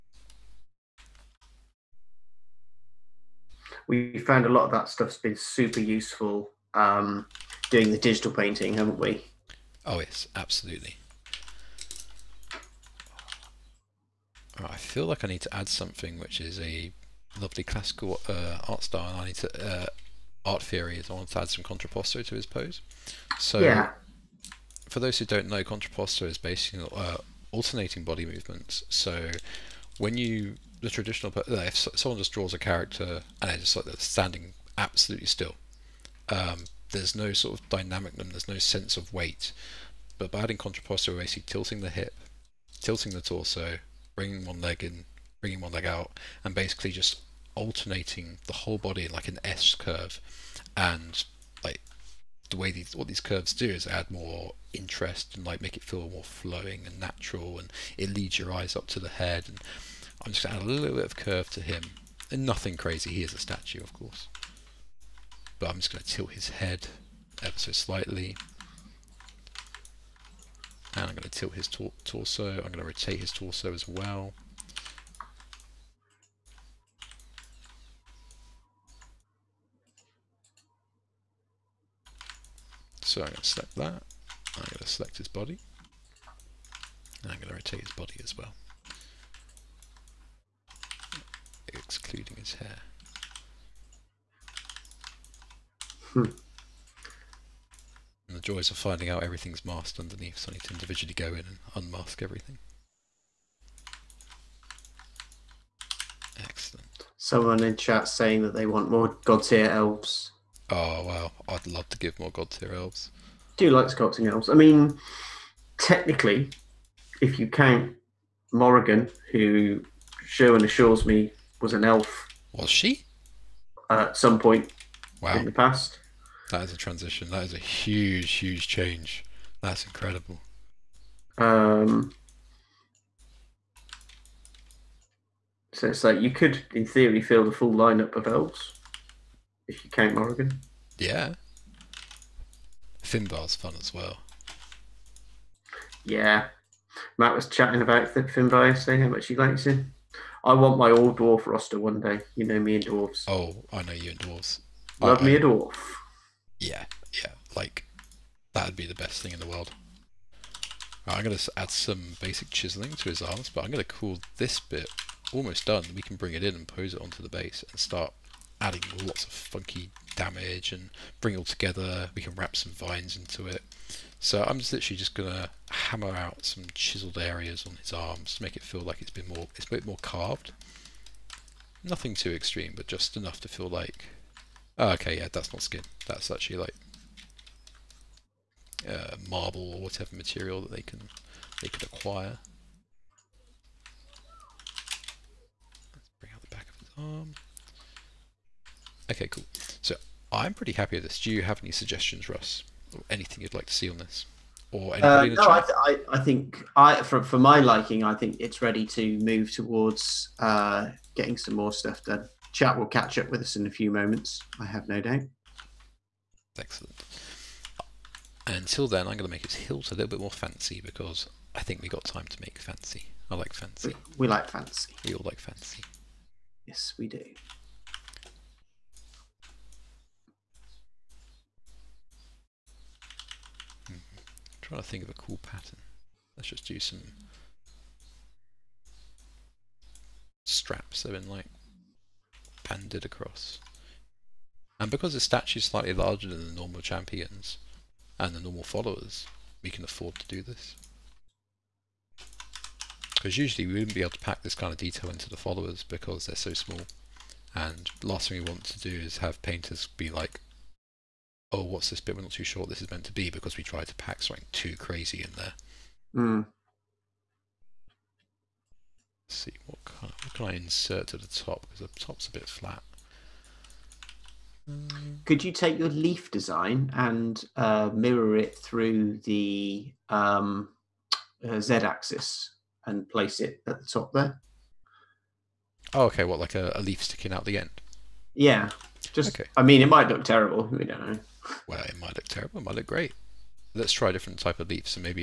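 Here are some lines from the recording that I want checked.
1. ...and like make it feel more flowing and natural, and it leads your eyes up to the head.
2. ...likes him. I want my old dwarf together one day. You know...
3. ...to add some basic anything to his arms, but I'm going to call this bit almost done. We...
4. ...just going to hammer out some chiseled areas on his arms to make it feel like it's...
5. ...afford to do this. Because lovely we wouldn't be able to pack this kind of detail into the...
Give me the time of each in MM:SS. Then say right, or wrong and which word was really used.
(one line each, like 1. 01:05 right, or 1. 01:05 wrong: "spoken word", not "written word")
1. 00:55 right
2. 02:29 wrong: "roster", not "together"
3. 02:41 wrong: "chiseling", not "anything"
4. 02:54 right
5. 04:09 wrong: "usually", not "lovely".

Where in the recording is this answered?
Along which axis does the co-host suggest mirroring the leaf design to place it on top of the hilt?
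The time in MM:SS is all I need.
04:41.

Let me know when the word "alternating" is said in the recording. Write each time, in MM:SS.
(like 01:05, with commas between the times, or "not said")
00:27, 00:47.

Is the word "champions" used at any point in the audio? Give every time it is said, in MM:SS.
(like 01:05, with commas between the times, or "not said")
04:06.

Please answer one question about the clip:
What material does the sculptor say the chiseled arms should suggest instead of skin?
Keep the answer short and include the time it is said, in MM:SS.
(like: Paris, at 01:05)
marble, at 03:09.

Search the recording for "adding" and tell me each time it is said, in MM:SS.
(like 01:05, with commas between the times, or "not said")
00:40, 02:48.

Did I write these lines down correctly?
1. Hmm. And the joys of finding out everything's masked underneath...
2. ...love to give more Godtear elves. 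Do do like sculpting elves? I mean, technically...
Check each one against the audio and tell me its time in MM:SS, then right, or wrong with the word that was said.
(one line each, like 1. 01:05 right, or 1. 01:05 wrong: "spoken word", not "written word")
1. 01:36 right
2. 01:51 right.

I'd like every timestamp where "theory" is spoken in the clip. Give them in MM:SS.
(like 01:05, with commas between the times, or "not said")
00:20, 02:16.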